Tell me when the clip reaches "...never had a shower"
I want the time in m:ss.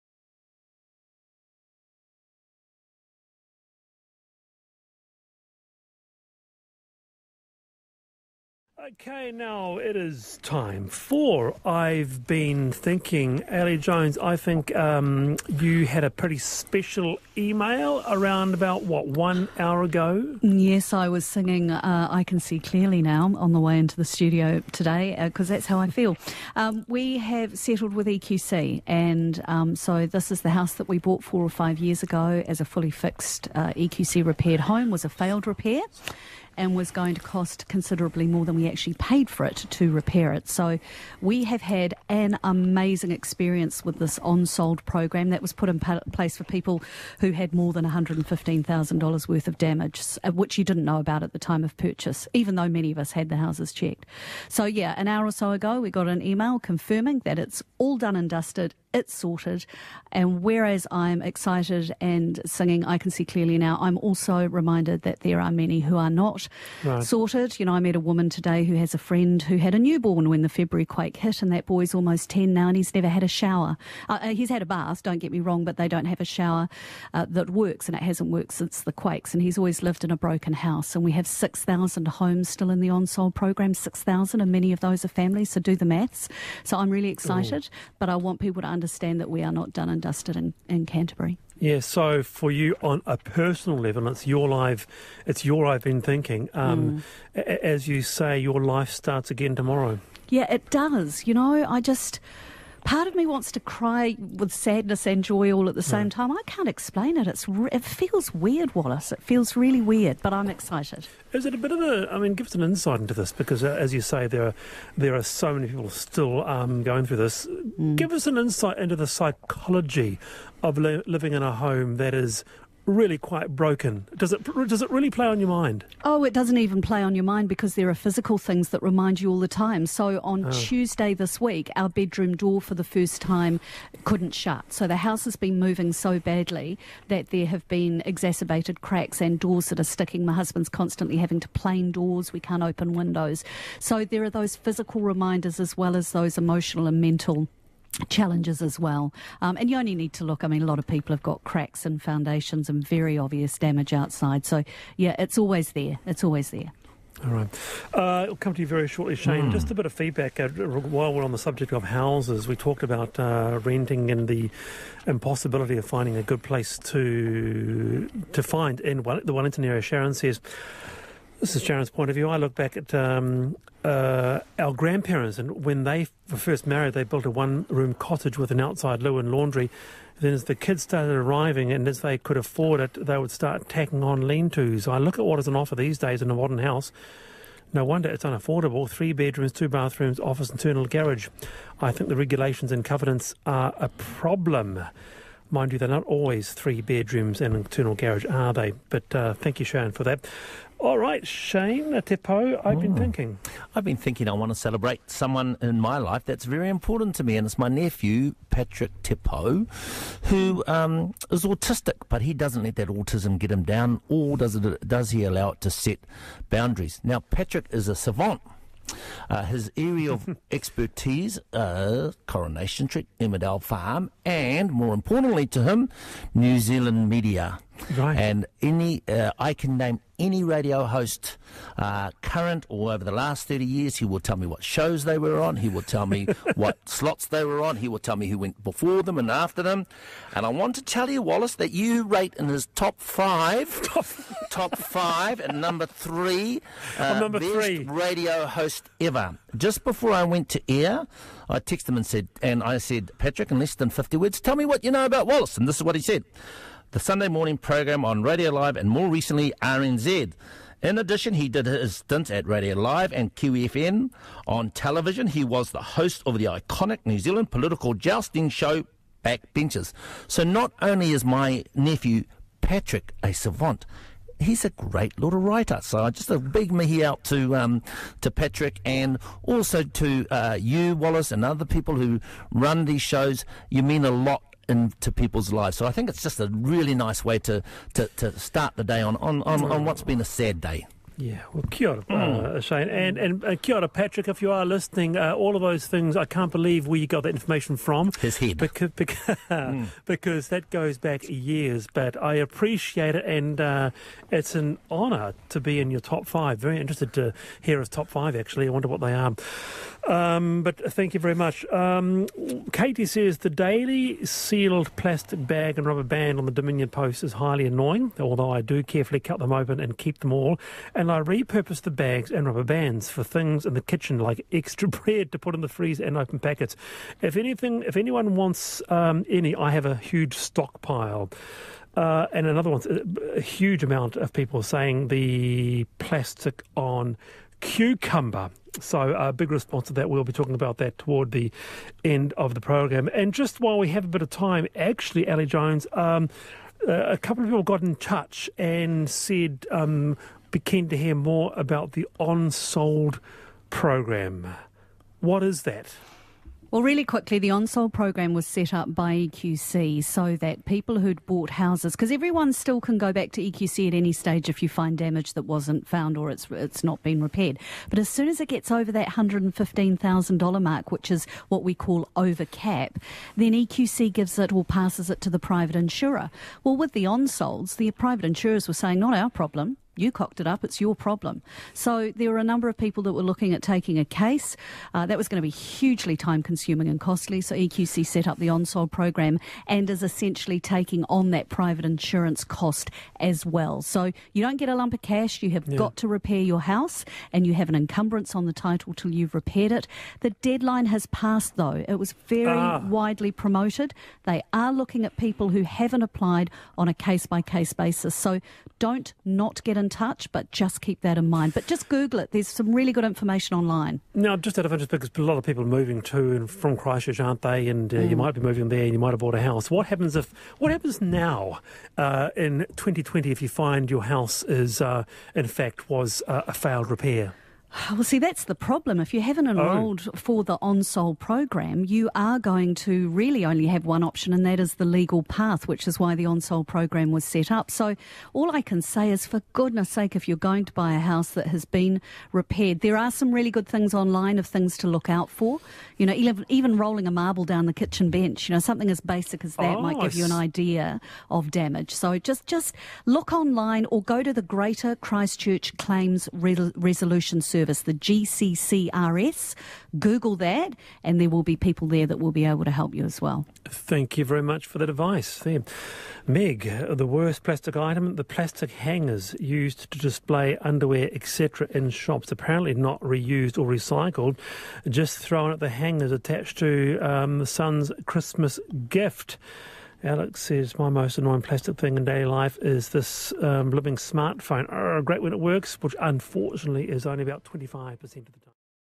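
1:12.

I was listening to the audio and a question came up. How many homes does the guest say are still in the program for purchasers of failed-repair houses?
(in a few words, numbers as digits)
6,000.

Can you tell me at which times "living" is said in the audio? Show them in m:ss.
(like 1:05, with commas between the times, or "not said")
2:01, 8:03.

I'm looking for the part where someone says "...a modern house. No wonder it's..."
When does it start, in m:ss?
3:06.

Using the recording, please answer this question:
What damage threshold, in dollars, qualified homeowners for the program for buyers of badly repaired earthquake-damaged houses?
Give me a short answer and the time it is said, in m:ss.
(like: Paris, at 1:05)
$115,000, at 0:47.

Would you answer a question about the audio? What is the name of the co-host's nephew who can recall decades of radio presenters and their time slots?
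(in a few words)
Patrick Te Pou.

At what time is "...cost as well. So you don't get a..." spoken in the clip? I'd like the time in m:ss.
6:32.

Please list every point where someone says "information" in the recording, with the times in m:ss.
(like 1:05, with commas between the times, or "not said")
4:57, 6:53.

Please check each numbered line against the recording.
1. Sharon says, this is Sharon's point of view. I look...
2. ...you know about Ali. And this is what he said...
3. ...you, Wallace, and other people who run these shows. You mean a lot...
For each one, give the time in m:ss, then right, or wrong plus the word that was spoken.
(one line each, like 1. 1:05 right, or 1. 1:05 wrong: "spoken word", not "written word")
1. 2:49 right
2. 4:14 wrong: "Wallace", not "Ali"
3. 4:40 right.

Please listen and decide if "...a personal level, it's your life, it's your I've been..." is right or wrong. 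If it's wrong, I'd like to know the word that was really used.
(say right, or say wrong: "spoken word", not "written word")
right.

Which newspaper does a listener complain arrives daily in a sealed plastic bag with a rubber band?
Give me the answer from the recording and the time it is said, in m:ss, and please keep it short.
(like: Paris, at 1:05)
Dominion Post, at 5:16.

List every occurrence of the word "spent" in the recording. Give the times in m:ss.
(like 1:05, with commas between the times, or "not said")
not said.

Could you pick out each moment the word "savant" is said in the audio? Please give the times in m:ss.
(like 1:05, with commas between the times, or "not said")
3:37, 4:33.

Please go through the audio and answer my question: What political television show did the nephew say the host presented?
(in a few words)
Backbenchers.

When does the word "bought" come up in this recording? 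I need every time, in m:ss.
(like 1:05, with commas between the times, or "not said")
0:30, 6:01, 6:59.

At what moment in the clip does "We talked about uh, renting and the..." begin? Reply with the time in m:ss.
2:42.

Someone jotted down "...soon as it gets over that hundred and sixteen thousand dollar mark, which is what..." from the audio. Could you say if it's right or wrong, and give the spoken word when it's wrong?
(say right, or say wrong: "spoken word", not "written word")
wrong: "fifteen", not "sixteen".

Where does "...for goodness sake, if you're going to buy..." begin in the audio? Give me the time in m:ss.
7:19.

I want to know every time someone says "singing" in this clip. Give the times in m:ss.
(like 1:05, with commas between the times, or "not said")
0:21, 1:02.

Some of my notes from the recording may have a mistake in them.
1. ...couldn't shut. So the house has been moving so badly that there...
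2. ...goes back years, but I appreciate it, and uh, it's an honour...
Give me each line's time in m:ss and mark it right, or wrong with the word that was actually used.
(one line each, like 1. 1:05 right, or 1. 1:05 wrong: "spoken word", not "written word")
1. 2:14 right
2. 5:00 right.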